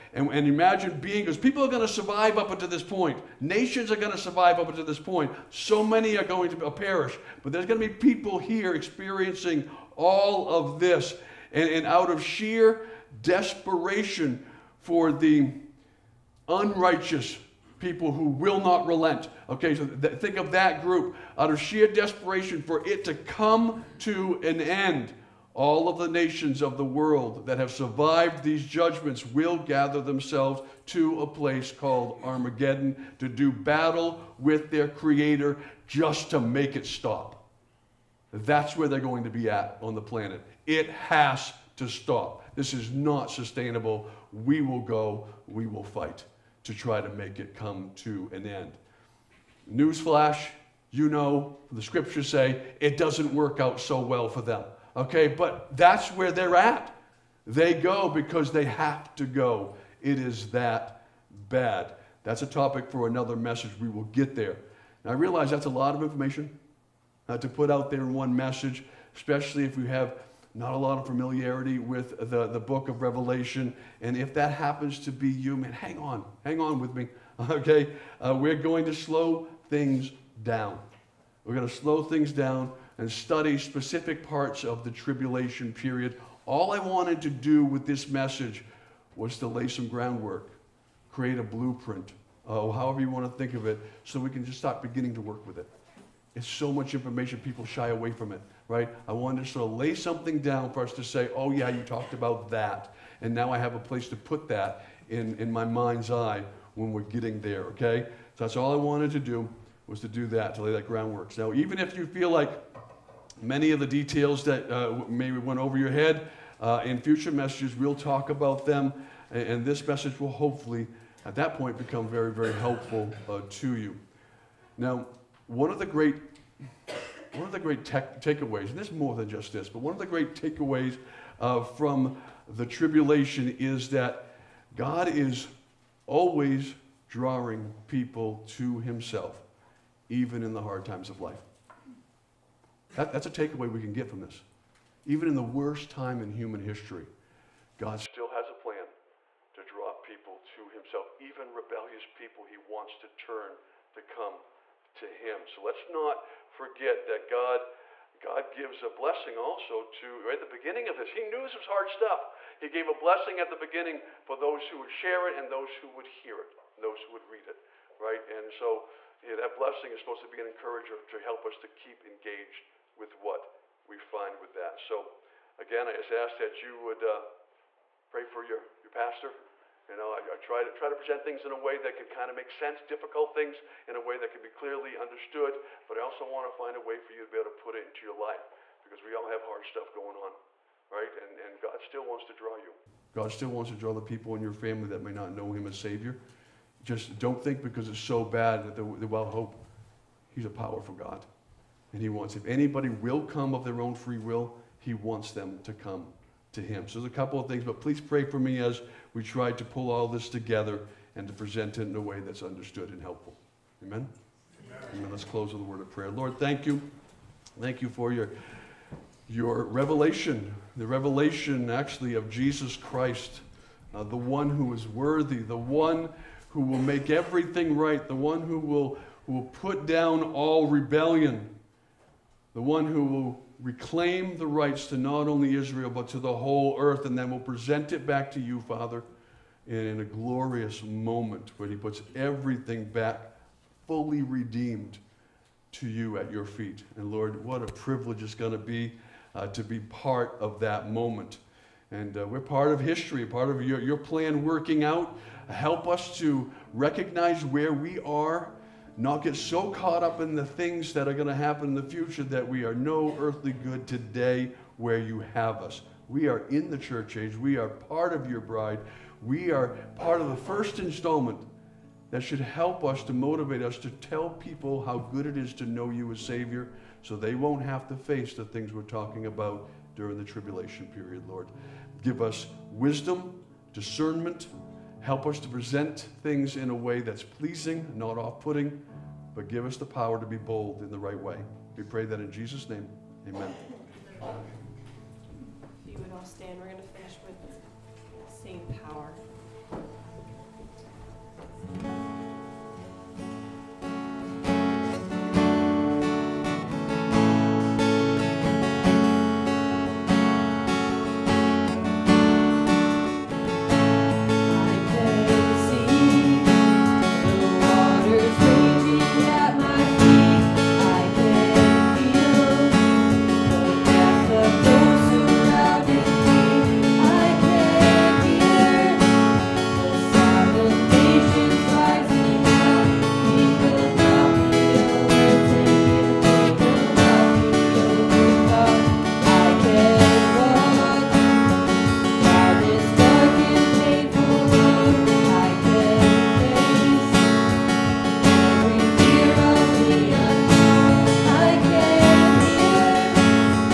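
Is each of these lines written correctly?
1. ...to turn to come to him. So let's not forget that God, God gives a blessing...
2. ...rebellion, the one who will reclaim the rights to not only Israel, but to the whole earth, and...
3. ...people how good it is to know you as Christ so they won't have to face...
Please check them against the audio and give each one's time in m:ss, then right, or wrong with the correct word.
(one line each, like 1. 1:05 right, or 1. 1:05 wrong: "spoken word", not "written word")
1. 2:32 right
2. 3:50 right
3. 4:34 wrong: "Savior", not "Christ".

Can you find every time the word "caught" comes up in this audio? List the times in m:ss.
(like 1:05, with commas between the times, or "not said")
4:19.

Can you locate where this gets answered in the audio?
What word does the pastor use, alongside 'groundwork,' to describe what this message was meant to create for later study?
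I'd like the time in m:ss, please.
1:31.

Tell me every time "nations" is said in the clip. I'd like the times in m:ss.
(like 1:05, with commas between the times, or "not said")
0:03, 0:26.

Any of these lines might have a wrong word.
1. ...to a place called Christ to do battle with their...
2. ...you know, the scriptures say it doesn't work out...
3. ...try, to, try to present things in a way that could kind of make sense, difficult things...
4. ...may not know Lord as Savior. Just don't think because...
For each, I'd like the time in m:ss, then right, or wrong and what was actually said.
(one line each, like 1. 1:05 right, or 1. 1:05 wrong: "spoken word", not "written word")
1. 0:30 wrong: "Armageddon", not "Christ"
2. 0:50 right
3. 3:00 right
4. 3:15 wrong: "Him", not "Lord".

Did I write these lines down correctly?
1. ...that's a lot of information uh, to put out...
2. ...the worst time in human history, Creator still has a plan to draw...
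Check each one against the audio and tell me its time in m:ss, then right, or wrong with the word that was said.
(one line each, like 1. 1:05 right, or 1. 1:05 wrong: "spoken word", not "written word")
1. 1:05 right
2. 2:25 wrong: "God", not "Creator".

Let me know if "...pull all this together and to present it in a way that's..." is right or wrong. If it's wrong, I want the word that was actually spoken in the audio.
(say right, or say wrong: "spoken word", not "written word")
right.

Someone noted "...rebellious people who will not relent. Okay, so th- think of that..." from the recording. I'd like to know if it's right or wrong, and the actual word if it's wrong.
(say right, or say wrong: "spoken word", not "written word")
wrong: "unrighteous", not "rebellious".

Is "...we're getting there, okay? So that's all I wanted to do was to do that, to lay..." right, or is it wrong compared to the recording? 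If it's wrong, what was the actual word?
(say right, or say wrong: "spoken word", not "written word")
right.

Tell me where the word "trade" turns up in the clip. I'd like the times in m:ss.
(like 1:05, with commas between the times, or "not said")
not said.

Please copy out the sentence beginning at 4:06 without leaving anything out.
And Lord, what a privilege it's going to be uh, to be part of that moment.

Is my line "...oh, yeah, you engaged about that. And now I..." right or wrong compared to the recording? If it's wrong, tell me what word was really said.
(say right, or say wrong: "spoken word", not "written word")
wrong: "talked", not "engaged".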